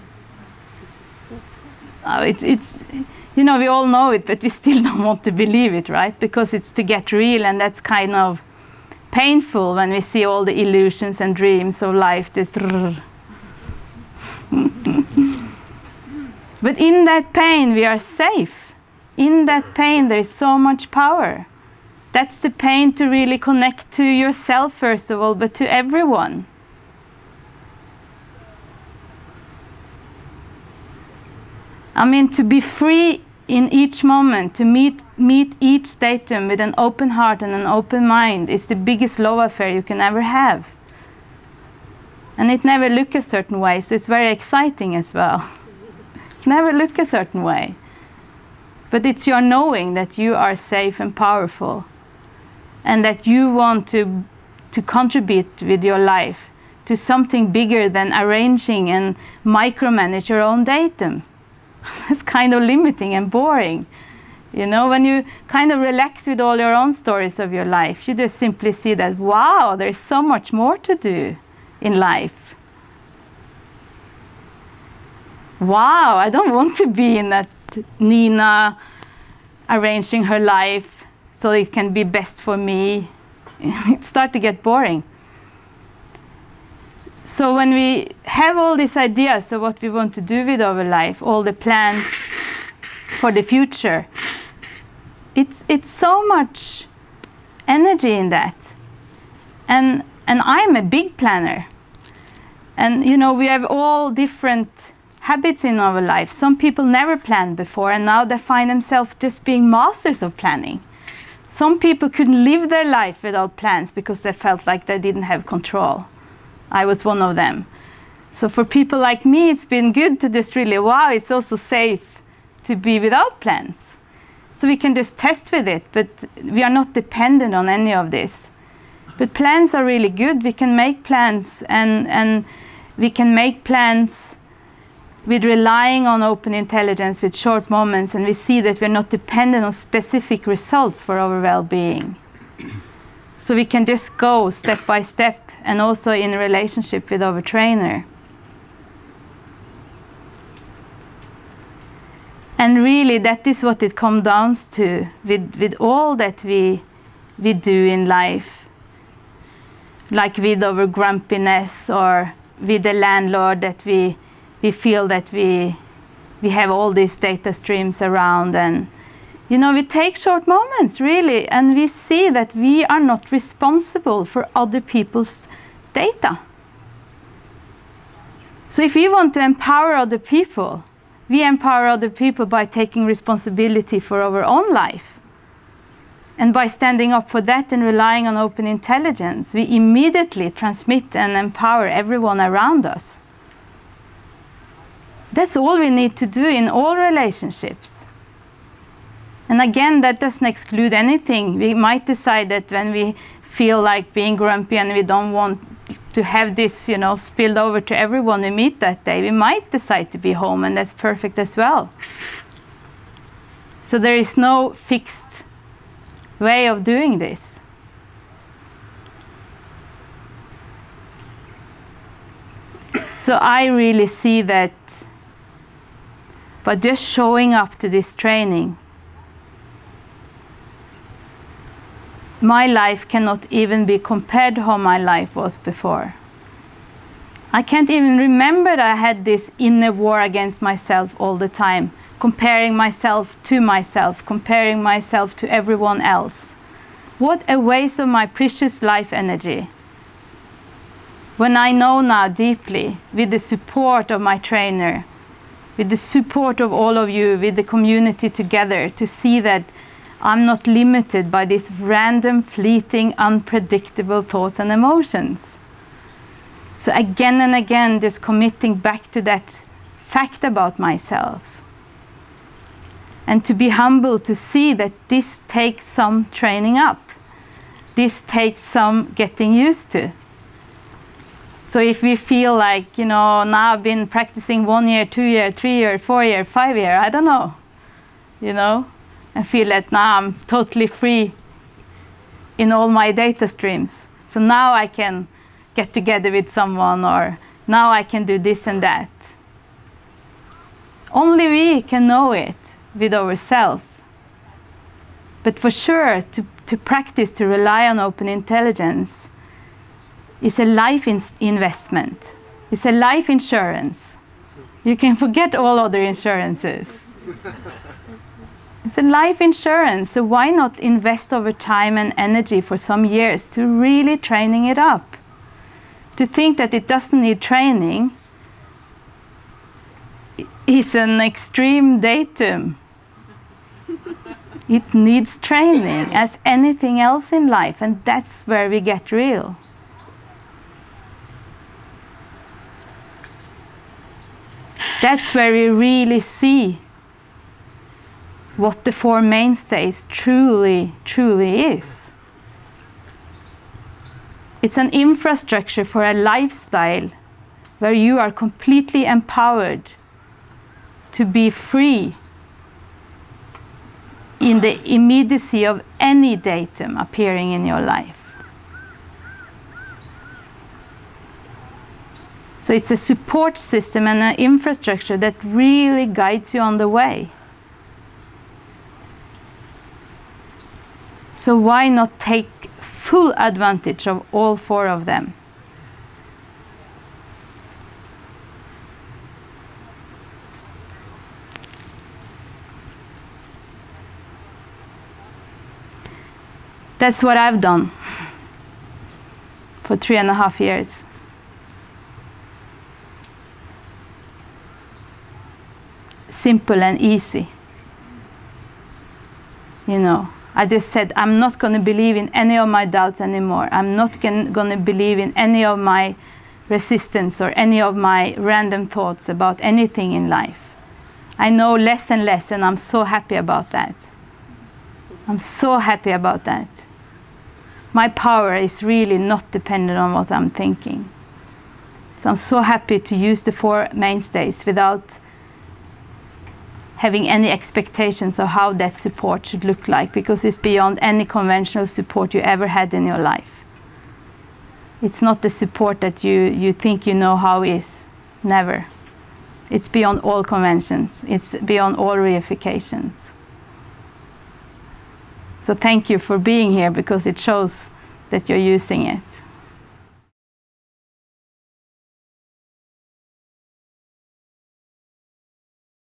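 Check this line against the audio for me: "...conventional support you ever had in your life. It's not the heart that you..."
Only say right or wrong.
wrong.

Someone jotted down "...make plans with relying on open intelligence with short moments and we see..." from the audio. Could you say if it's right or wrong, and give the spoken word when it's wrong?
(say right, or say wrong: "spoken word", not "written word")
right.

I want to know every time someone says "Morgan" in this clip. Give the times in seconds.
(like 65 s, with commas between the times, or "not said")
not said.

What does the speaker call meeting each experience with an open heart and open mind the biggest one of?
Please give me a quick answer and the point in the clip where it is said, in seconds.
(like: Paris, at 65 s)
love affair, at 39 s.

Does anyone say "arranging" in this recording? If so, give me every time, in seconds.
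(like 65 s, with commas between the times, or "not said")
58 s, 79 s.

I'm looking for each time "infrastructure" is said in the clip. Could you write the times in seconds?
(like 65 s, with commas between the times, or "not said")
354 s, 374 s.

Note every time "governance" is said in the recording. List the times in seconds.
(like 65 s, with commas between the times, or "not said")
not said.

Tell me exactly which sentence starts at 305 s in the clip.
But for sure, to, to practice, to rely on open intelligence is a life in investment.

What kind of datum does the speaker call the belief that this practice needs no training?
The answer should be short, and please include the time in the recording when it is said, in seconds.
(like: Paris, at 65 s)
an extreme datum, at 331 s.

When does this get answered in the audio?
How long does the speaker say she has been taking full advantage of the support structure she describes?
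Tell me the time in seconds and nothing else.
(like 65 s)
399 s.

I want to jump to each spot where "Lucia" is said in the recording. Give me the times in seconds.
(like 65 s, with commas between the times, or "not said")
not said.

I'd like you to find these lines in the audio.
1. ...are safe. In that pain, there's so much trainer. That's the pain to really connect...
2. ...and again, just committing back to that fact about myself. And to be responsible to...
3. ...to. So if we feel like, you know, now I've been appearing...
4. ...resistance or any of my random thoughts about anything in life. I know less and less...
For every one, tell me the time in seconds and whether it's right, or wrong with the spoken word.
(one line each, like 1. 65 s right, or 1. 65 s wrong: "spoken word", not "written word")
1. 17 s wrong: "power", not "trainer"
2. 267 s wrong: "humble", not "responsible"
3. 279 s wrong: "practicing", not "appearing"
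4. 416 s right.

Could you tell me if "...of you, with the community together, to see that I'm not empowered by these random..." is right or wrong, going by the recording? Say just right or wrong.
wrong.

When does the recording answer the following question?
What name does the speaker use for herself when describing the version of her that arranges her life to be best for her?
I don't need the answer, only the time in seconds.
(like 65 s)
77 s.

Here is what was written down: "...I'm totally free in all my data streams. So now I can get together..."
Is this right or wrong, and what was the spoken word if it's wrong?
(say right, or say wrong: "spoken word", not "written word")
right.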